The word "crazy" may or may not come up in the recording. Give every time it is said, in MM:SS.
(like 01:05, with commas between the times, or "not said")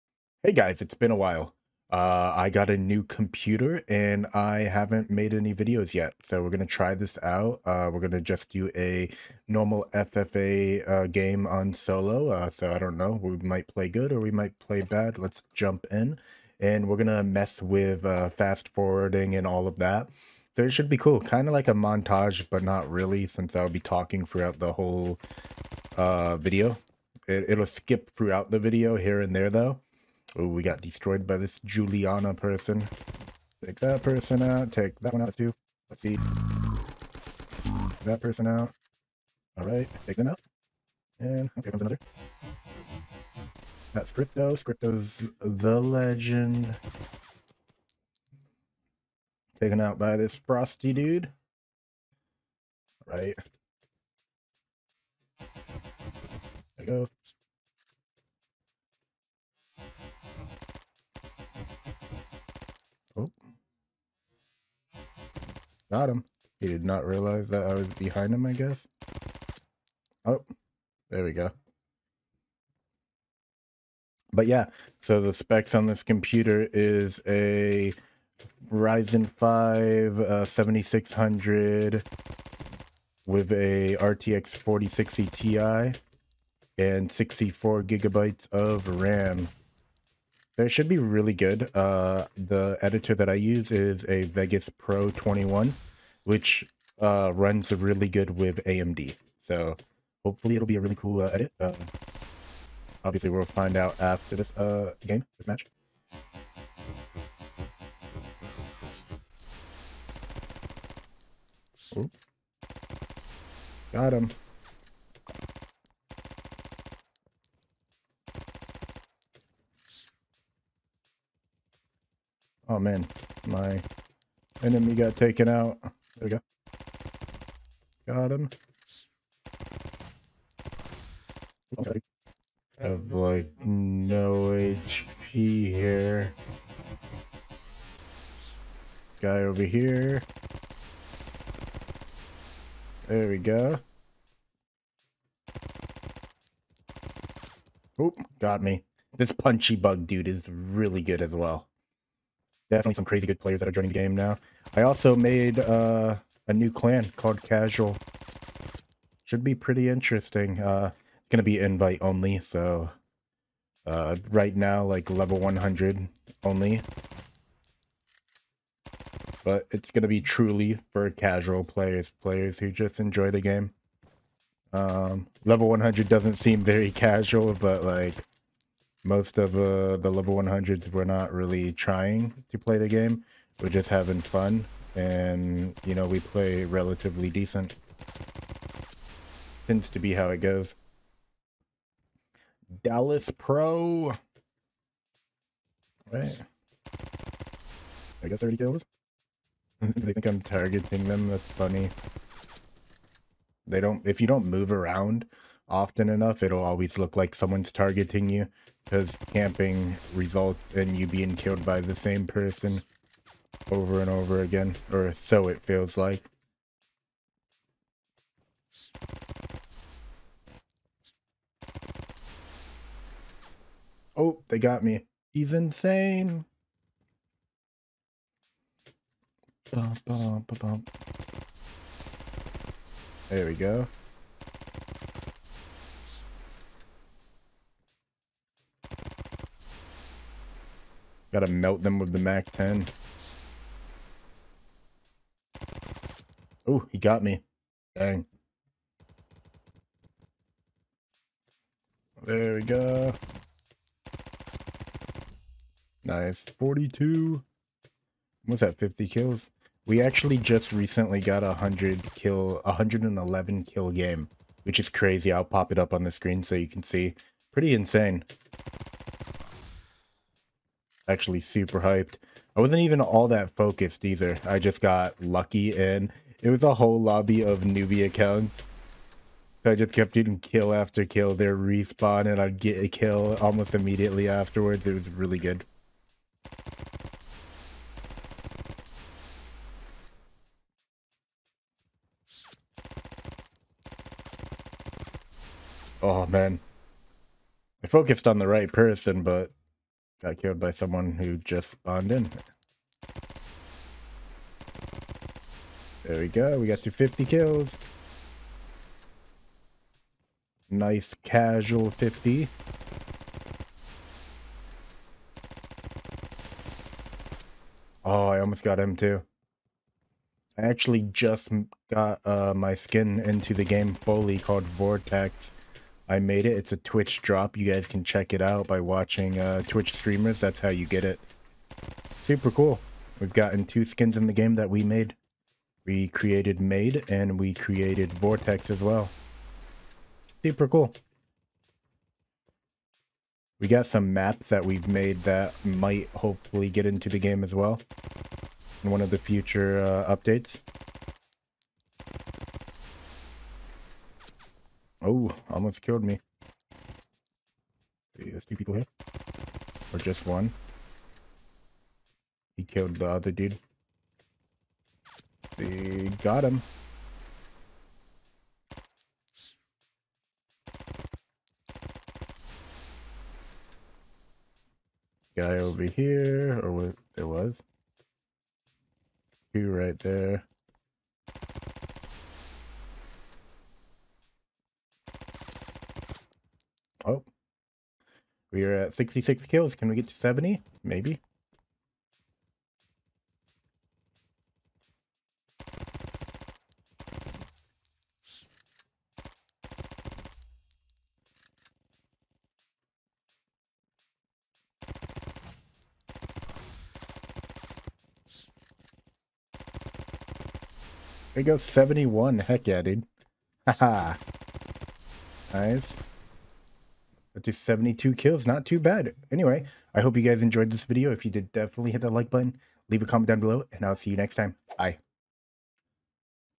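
02:33, 04:24.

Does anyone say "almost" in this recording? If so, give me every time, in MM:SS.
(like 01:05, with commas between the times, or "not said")
04:43, 05:18, 05:55.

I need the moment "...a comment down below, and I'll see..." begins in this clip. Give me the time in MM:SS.
07:03.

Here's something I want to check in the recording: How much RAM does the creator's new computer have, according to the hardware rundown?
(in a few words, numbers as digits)
64 gigabytes.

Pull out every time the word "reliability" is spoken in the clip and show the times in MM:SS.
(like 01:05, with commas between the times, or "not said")
not said.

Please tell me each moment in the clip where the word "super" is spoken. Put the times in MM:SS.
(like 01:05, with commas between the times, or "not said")
04:31, 05:32, 05:40.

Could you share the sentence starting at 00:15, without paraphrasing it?
Let's jump in and we're going to mess with uh, fast forwarding and all of that.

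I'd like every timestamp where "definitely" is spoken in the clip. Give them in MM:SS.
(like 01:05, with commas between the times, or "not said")
02:32, 07:01.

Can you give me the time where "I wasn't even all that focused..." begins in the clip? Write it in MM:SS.
04:32.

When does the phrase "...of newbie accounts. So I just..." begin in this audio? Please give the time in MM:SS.
04:37.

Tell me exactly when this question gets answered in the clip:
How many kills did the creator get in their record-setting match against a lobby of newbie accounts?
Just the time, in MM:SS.
04:22.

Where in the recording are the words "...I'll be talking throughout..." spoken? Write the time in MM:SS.
00:23.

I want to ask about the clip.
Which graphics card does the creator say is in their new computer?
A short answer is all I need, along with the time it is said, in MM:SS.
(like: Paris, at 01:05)
RTX 4060 Ti, at 01:23.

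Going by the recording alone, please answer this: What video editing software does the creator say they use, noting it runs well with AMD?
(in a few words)
Vegas Pro 21.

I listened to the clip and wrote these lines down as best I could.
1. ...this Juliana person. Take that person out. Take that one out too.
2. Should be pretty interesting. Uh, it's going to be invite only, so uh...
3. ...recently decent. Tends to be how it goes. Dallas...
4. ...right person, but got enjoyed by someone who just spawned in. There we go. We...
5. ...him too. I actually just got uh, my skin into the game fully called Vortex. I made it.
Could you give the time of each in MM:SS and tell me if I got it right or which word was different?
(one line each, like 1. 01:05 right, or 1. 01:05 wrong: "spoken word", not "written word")
1. 00:31 right
2. 02:39 right
3. 03:06 wrong: "relatively", not "recently"
4. 04:58 wrong: "killed", not "enjoyed"
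5. 05:18 right.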